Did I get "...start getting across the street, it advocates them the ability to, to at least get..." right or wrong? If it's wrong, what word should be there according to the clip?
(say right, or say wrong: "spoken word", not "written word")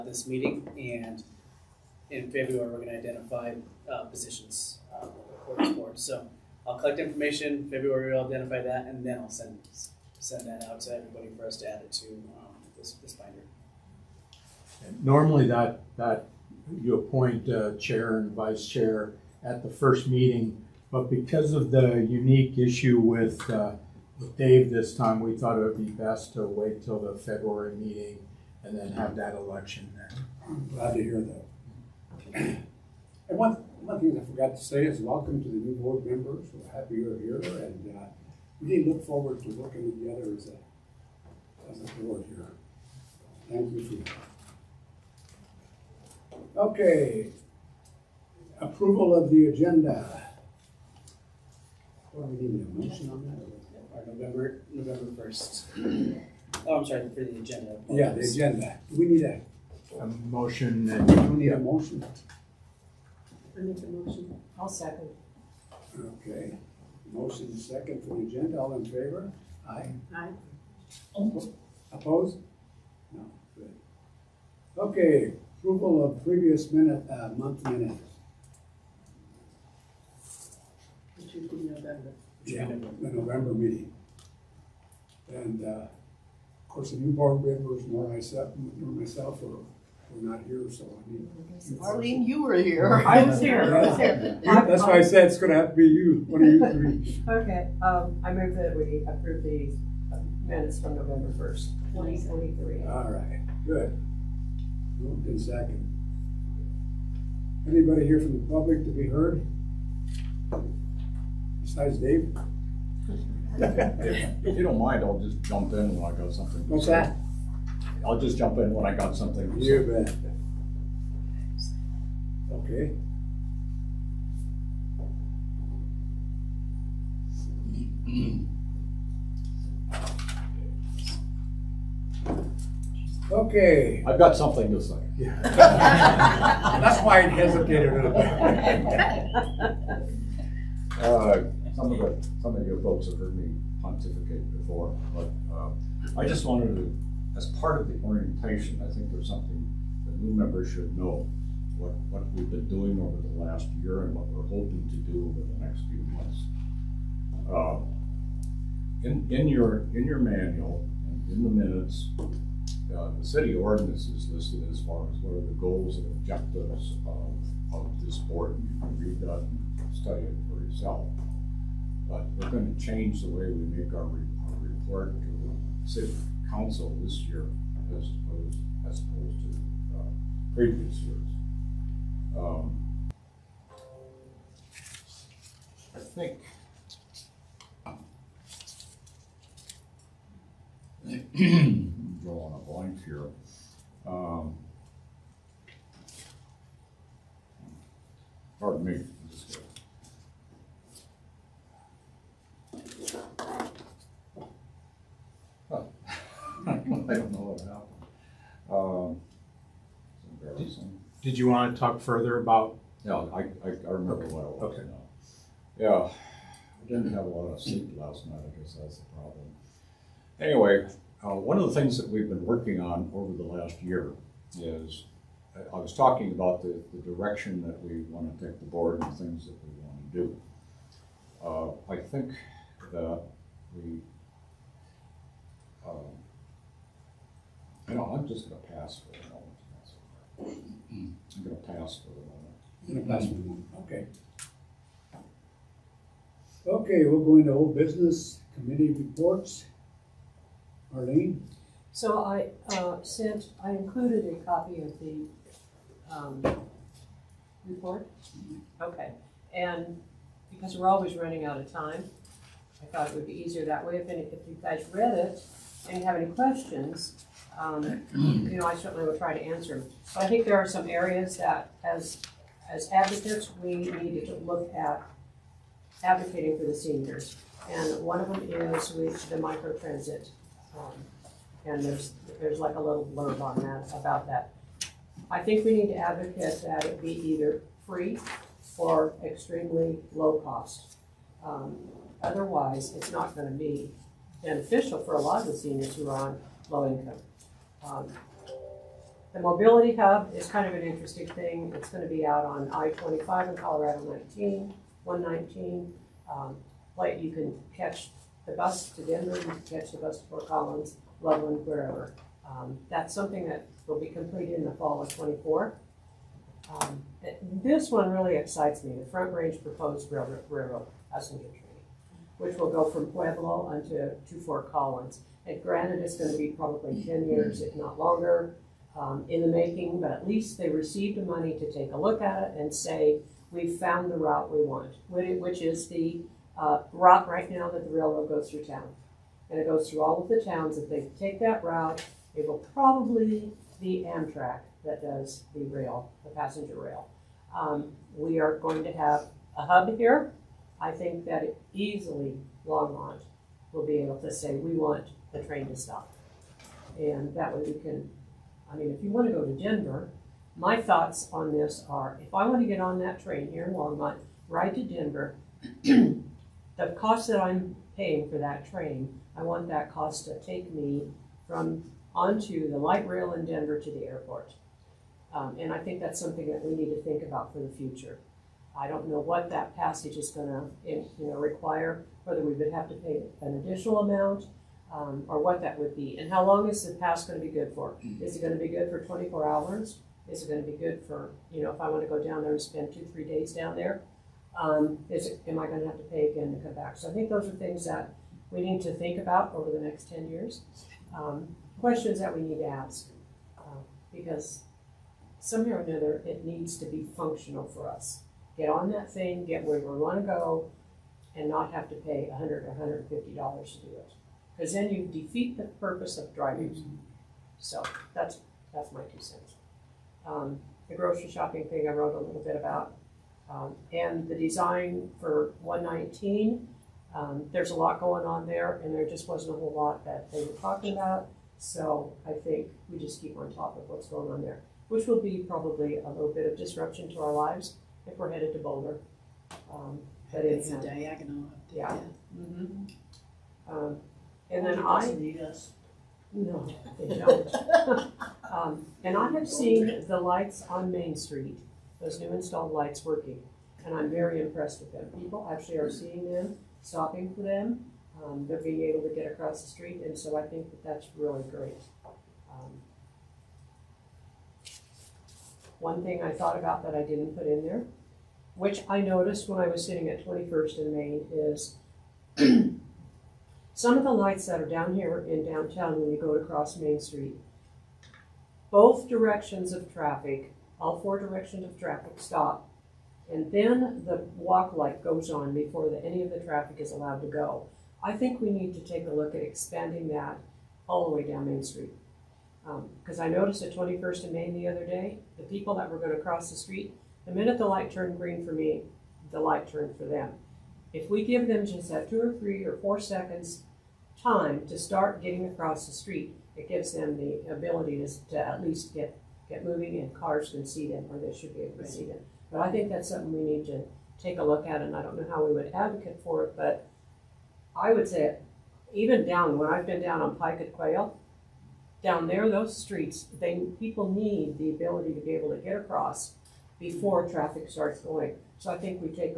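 wrong: "gives", not "advocates".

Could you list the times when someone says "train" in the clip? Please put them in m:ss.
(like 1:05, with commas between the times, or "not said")
5:21, 5:55, 6:03, 6:08.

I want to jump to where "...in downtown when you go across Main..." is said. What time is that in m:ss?
7:55.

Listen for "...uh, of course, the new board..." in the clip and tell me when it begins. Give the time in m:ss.
1:25.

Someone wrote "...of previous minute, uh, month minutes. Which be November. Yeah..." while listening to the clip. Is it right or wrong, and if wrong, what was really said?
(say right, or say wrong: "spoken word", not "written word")
right.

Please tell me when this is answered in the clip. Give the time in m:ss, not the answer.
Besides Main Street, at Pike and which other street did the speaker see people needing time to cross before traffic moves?
8:40.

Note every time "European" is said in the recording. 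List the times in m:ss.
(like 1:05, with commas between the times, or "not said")
not said.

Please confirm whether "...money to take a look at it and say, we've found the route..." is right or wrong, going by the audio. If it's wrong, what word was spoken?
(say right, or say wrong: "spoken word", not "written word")
right.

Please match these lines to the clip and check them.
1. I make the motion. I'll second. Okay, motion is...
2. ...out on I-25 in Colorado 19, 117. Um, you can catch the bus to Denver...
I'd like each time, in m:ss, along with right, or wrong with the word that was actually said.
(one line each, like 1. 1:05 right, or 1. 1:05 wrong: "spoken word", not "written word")
1. 1:03 right
2. 5:02 wrong: "119", not "117".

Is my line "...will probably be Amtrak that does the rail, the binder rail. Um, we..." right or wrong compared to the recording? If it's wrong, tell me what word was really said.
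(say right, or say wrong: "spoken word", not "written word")
wrong: "passenger", not "binder".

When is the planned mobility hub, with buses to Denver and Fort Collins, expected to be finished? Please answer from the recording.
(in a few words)
fall of 2024.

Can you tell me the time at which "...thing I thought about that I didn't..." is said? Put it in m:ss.
7:46.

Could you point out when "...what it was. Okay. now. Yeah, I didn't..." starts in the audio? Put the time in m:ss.
3:34.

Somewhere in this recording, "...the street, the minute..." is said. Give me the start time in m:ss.
8:16.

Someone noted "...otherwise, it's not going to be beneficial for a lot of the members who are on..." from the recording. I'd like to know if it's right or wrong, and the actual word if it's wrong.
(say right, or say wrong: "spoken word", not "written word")
wrong: "seniors", not "members".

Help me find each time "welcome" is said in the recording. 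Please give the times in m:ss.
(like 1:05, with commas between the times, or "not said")
0:35.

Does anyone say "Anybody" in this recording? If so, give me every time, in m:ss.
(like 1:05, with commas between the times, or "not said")
1:47.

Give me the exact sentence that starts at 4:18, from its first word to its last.
Okay, and because we're always running out of time, I thought it would be easier that way.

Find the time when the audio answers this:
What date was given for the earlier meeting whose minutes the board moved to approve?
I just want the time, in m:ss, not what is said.
1:40.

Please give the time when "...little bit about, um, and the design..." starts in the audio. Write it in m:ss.
7:02.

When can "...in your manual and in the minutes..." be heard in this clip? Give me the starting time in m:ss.
2:39.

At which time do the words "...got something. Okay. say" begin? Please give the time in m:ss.
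1:56.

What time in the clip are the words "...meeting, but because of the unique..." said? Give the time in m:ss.
0:20.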